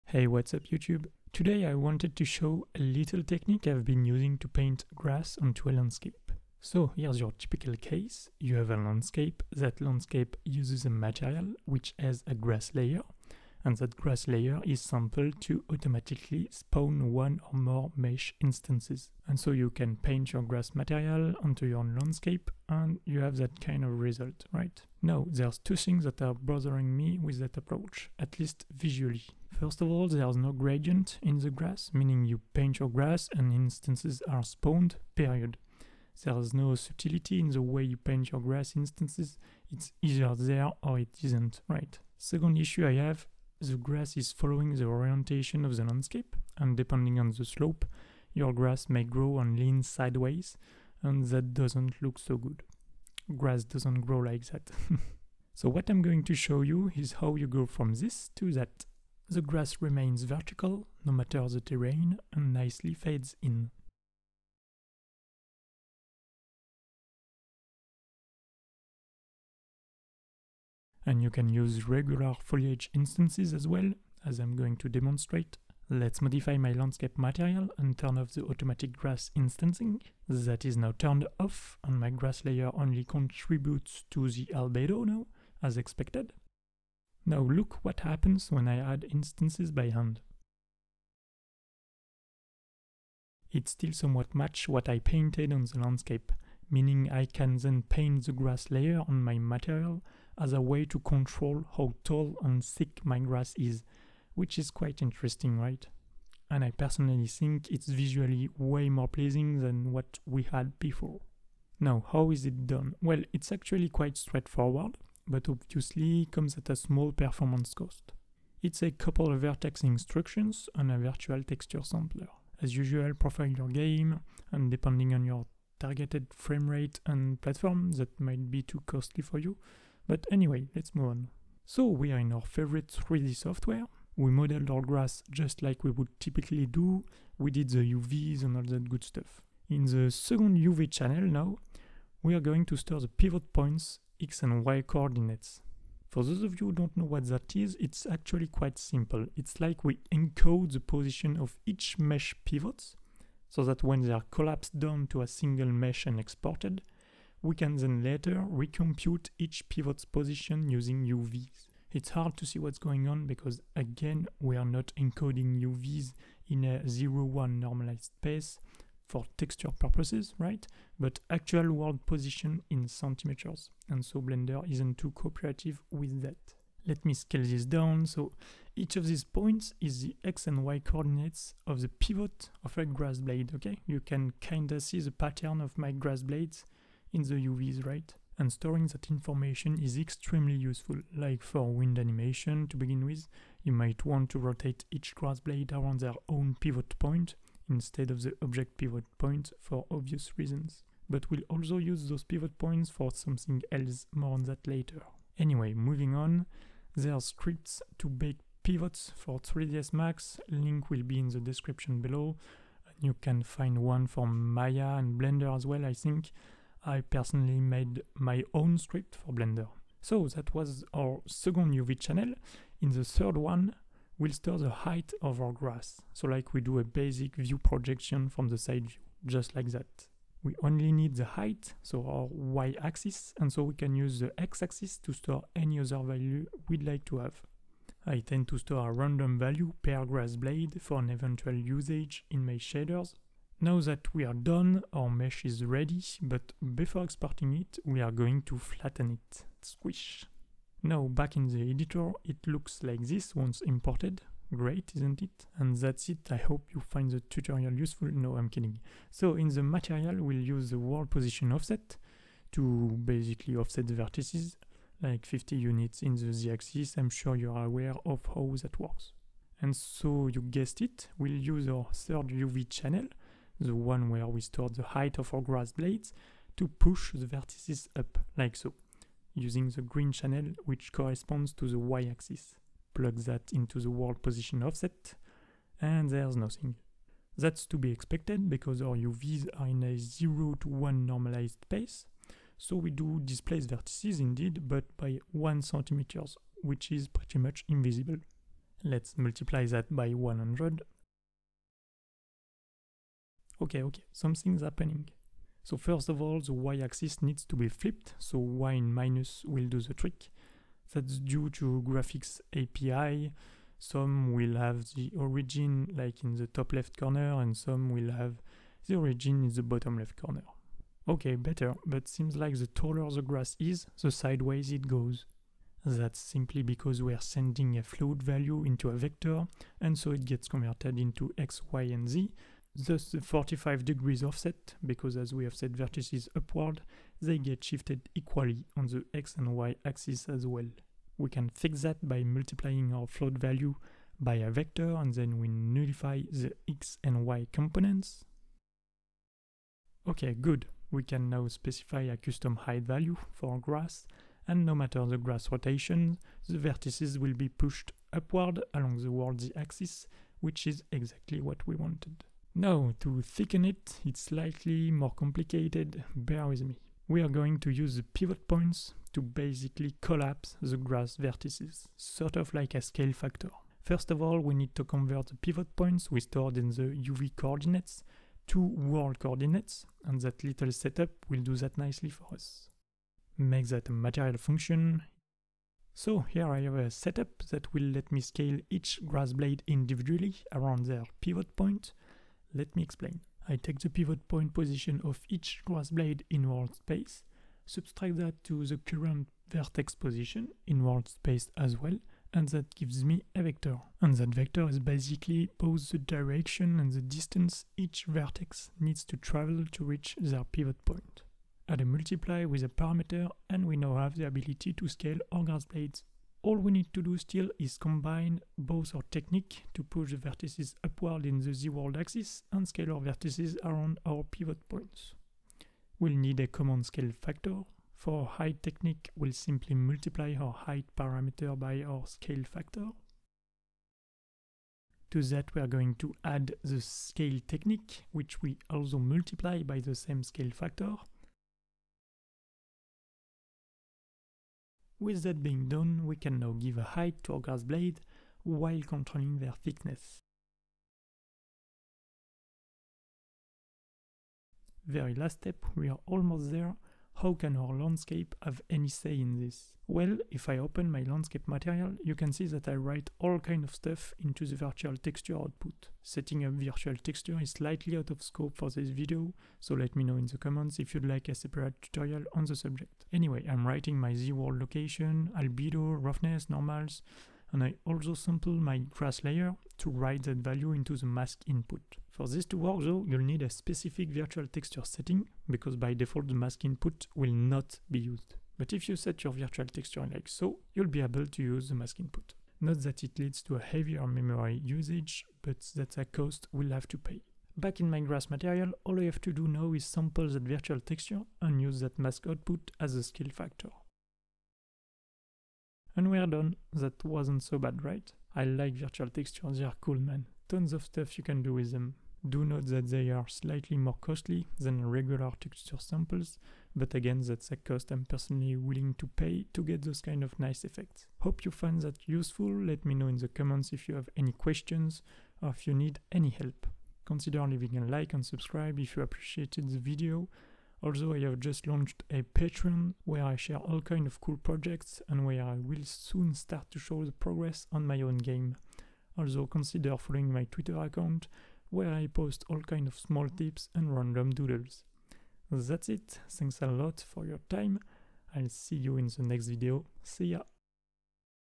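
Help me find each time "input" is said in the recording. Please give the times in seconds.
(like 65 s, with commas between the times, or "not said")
481 s, 486 s, 492 s.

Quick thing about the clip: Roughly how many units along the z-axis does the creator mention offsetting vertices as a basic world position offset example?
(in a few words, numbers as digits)
50.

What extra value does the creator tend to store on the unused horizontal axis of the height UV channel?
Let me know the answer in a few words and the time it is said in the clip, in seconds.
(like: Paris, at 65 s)
A random value per grass blade, at 238 s.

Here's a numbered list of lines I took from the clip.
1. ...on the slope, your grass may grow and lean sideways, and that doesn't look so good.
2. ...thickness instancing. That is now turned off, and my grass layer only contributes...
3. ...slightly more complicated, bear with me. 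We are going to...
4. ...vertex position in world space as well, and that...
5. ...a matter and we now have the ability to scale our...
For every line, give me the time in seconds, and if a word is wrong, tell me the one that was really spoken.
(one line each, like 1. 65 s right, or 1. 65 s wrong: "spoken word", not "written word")
1. 47 s right
2. 78 s wrong: "grass", not "thickness"
3. 364 s right
4. 399 s right
5. 412 s wrong: "parameter", not "matter".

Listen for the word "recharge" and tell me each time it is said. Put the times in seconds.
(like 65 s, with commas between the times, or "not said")
not said.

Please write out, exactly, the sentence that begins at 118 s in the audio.
It's a couple of vertex instructions on a virtual texture sampler.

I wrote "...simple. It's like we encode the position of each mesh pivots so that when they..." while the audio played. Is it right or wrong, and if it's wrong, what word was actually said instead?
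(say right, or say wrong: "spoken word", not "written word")
right.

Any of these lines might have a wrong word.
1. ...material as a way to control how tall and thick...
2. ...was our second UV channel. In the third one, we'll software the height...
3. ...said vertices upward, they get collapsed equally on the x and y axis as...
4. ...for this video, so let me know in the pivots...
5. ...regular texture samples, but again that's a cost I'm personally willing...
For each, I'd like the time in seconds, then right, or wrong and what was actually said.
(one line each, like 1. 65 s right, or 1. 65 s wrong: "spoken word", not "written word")
1. 99 s right
2. 220 s wrong: "store", not "software"
3. 335 s wrong: "shifted", not "collapsed"
4. 468 s wrong: "comments", not "pivots"
5. 514 s right.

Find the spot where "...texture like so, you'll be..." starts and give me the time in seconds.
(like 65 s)
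489 s.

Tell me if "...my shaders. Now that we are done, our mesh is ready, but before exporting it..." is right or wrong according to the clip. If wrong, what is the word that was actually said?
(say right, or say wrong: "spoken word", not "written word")
right.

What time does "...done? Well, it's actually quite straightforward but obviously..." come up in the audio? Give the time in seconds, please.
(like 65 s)
112 s.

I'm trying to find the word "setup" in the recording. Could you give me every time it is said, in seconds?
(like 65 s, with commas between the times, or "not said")
380 s, 386 s.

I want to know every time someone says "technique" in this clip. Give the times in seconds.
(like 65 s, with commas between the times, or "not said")
3 s, 419 s, 428 s, 437 s.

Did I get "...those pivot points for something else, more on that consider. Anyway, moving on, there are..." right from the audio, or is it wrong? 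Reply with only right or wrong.
wrong.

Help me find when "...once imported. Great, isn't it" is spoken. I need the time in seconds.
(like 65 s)
253 s.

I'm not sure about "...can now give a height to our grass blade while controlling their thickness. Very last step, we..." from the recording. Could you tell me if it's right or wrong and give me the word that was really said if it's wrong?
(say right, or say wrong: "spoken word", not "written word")
right.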